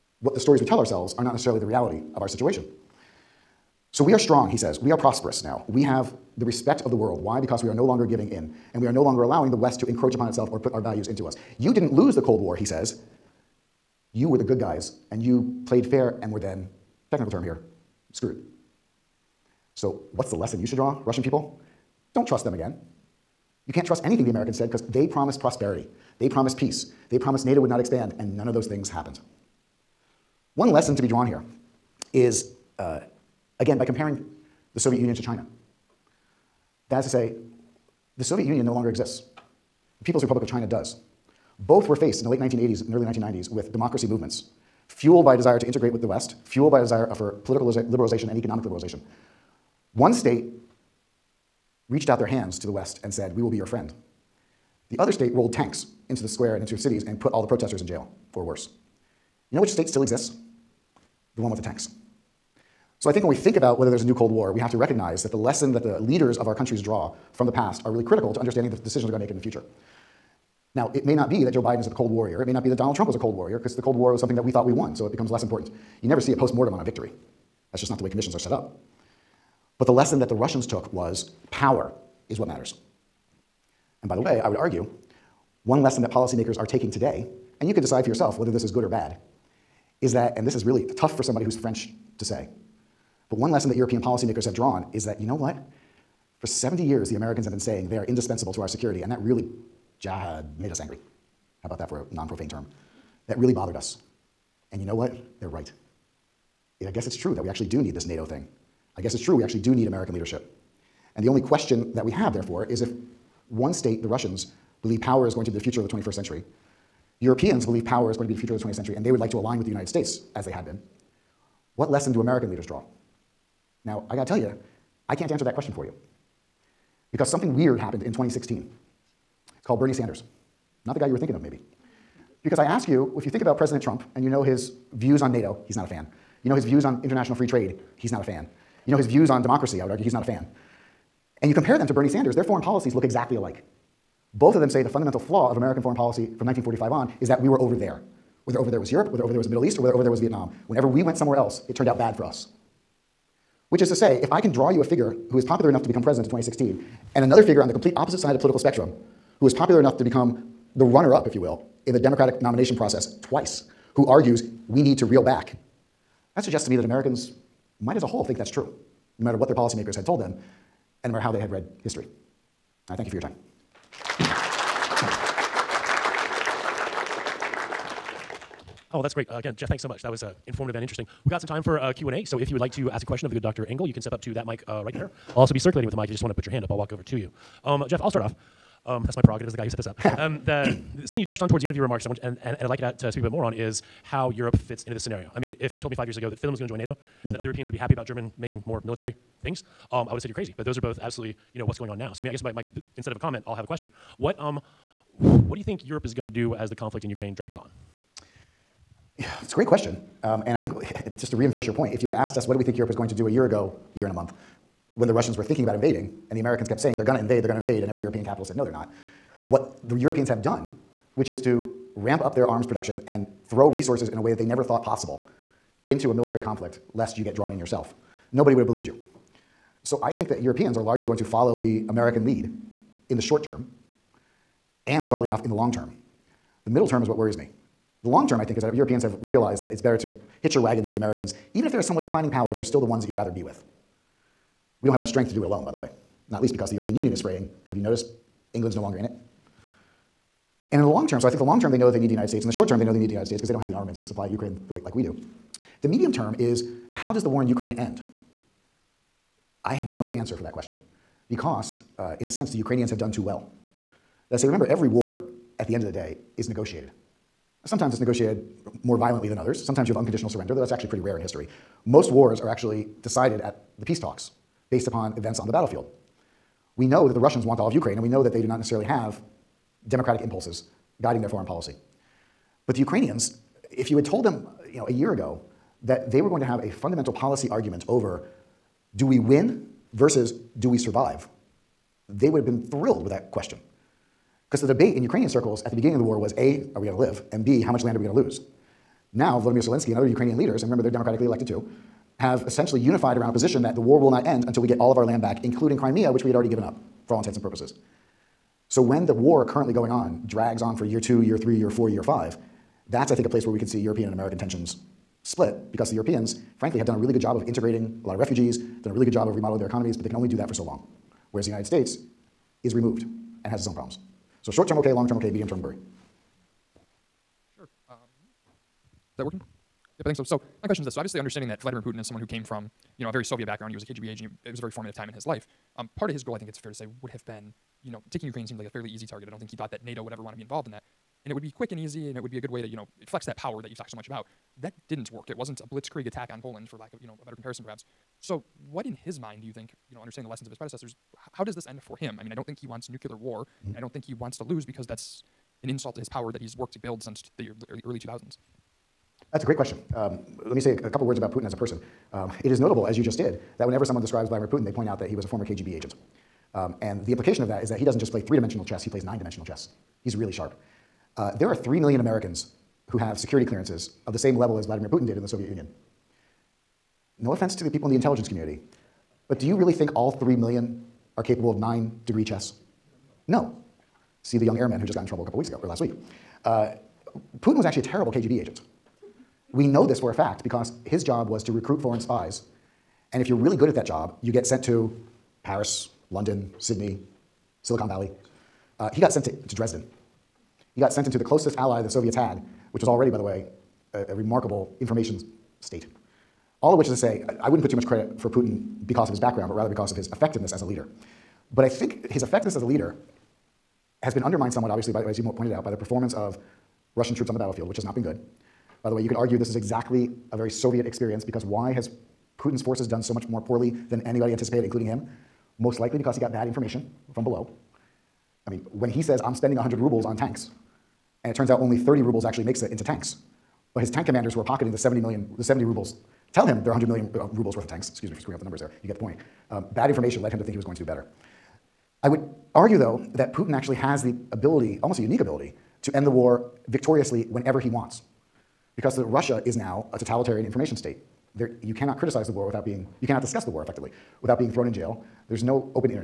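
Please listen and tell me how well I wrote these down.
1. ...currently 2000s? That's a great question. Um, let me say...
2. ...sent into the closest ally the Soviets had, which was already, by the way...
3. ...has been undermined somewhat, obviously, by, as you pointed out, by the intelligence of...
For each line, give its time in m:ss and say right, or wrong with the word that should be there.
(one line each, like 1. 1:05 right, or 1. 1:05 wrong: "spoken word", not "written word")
1. 5:57 wrong: "early", not "currently"
2. 6:40 right
3. 6:54 wrong: "performance", not "intelligence".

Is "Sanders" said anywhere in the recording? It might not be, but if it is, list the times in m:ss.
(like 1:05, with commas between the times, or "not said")
2:09, 2:22.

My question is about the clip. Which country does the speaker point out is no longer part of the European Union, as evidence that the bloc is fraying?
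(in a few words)
England.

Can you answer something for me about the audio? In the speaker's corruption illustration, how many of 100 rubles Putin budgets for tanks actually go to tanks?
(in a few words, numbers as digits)
30 rubles.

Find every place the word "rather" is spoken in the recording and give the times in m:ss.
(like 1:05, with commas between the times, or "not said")
4:03, 6:49.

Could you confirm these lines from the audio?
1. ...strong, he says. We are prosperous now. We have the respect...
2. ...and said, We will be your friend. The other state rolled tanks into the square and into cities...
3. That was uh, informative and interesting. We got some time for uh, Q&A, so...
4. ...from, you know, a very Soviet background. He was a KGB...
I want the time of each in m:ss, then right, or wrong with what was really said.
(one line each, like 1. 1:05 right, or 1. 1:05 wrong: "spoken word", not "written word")
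1. 0:04 right
2. 0:53 right
3. 3:00 right
4. 5:32 right.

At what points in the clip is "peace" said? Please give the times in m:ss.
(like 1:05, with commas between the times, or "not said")
0:26, 4:33.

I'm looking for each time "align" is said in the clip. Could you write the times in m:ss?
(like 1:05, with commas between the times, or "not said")
1:59.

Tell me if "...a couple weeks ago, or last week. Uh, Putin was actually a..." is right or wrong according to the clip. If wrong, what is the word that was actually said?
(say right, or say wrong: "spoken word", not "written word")
right.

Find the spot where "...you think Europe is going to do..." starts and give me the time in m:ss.
3:25.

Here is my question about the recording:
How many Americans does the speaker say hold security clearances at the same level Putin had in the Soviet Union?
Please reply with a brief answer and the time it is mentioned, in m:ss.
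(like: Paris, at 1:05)
3 million, at 6:11.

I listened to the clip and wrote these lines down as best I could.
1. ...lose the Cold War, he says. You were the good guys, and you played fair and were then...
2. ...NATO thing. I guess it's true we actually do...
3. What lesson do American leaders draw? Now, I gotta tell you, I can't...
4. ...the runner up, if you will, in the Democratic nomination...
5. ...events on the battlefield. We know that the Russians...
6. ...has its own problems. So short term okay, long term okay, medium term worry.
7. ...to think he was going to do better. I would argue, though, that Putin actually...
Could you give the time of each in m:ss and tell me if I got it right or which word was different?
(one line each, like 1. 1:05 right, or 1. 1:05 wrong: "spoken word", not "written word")
1. 0:11 right
2. 1:48 right
3. 2:01 right
4. 2:40 right
5. 4:35 right
6. 5:23 right
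7. 7:20 right.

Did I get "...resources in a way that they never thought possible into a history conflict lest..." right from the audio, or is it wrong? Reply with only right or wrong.
wrong.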